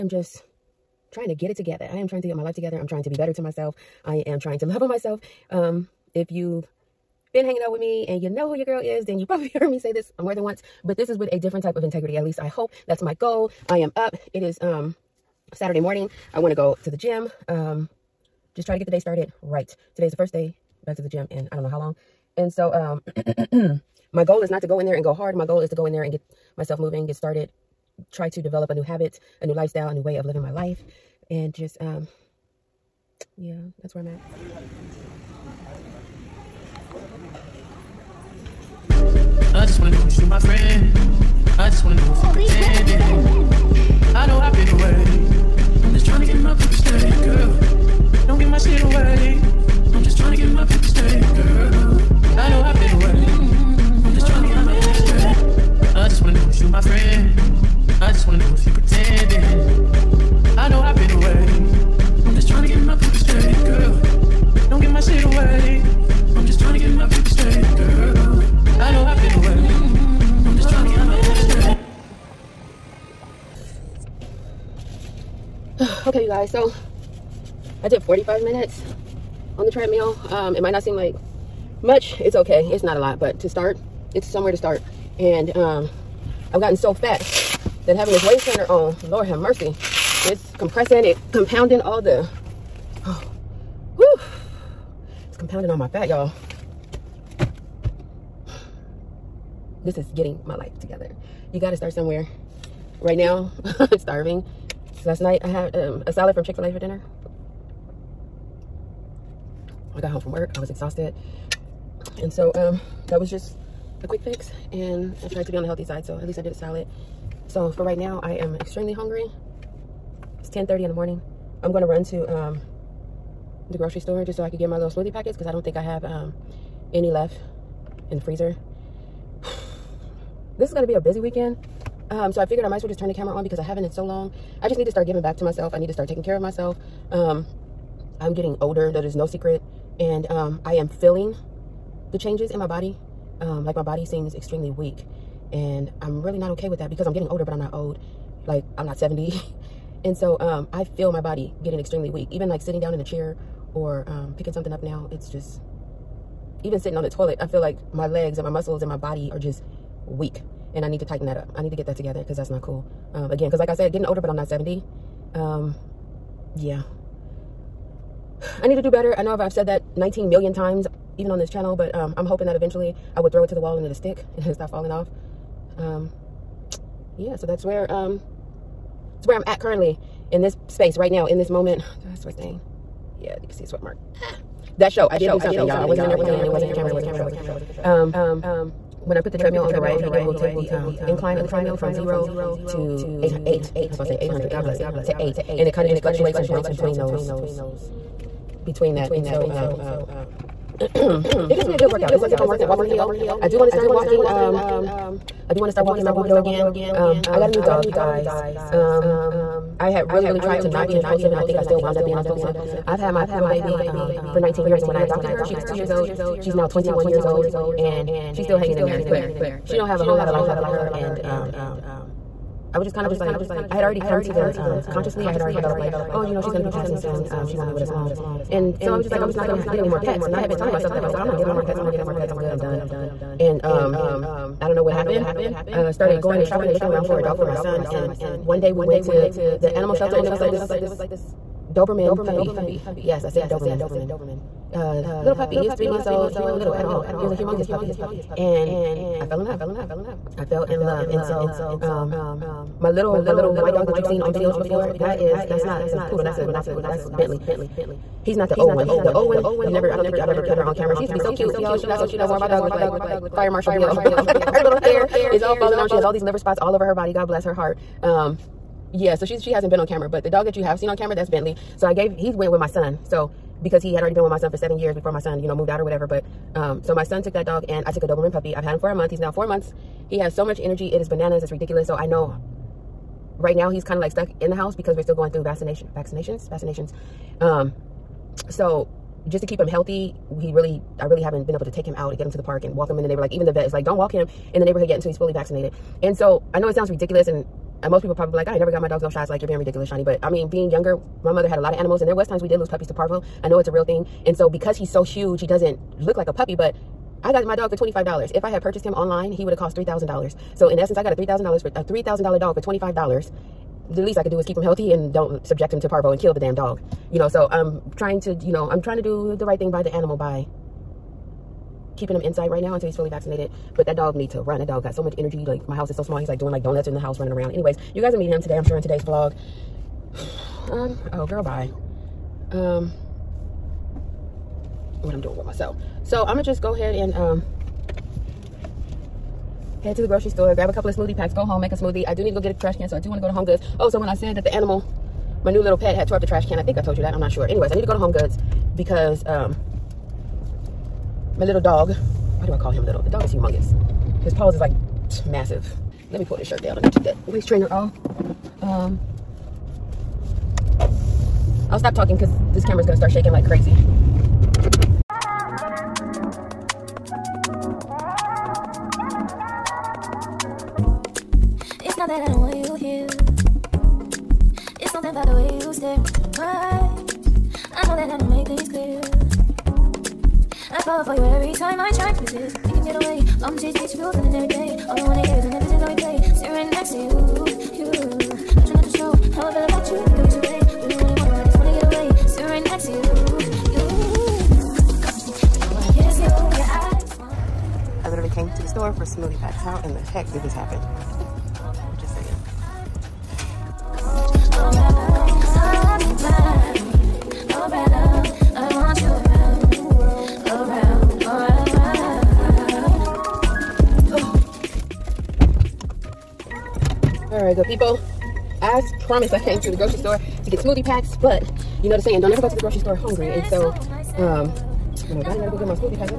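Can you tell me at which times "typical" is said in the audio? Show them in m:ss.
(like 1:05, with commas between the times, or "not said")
not said.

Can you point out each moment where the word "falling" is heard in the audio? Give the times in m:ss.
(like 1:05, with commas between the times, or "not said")
2:54, 4:25.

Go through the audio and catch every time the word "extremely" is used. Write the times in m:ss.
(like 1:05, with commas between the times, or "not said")
1:58, 2:24, 2:31.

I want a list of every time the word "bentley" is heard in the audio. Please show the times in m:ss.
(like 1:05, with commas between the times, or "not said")
4:17, 4:31.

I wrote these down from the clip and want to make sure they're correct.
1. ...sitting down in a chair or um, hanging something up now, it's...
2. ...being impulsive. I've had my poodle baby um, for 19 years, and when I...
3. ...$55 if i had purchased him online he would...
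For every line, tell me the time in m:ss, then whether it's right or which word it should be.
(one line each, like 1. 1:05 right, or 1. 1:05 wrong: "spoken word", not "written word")
1. 2:32 wrong: "picking", not "hanging"
2. 3:32 right
3. 5:07 wrong: "25", not "55".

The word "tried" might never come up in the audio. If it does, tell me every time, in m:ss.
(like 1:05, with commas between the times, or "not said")
1:55, 3:30.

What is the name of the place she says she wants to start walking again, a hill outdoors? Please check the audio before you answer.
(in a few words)
Mount Rubidoux.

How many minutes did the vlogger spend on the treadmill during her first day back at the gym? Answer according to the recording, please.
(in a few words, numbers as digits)
45.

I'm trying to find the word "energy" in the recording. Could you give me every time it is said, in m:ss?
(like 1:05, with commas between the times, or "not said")
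4:40, 5:25.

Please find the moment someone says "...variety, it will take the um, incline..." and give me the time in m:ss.
3:09.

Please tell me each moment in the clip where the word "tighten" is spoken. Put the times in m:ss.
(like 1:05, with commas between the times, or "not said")
2:41.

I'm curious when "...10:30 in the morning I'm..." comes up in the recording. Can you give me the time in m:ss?
2:00.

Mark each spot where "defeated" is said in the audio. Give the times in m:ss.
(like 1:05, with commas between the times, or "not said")
not said.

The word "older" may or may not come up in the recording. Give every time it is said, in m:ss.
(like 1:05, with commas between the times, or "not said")
2:18, 2:27, 2:44.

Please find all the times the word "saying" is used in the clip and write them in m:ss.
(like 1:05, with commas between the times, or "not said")
7:02.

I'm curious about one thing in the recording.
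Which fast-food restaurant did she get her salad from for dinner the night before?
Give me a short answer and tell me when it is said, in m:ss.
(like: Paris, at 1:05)
Chick-fil-A, at 1:46.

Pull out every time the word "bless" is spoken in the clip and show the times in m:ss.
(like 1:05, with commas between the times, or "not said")
3:14, 4:27.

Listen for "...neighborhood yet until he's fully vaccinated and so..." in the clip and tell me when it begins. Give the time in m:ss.
4:54.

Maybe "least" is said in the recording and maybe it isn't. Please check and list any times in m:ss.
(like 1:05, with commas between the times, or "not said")
0:12, 1:56, 5:13.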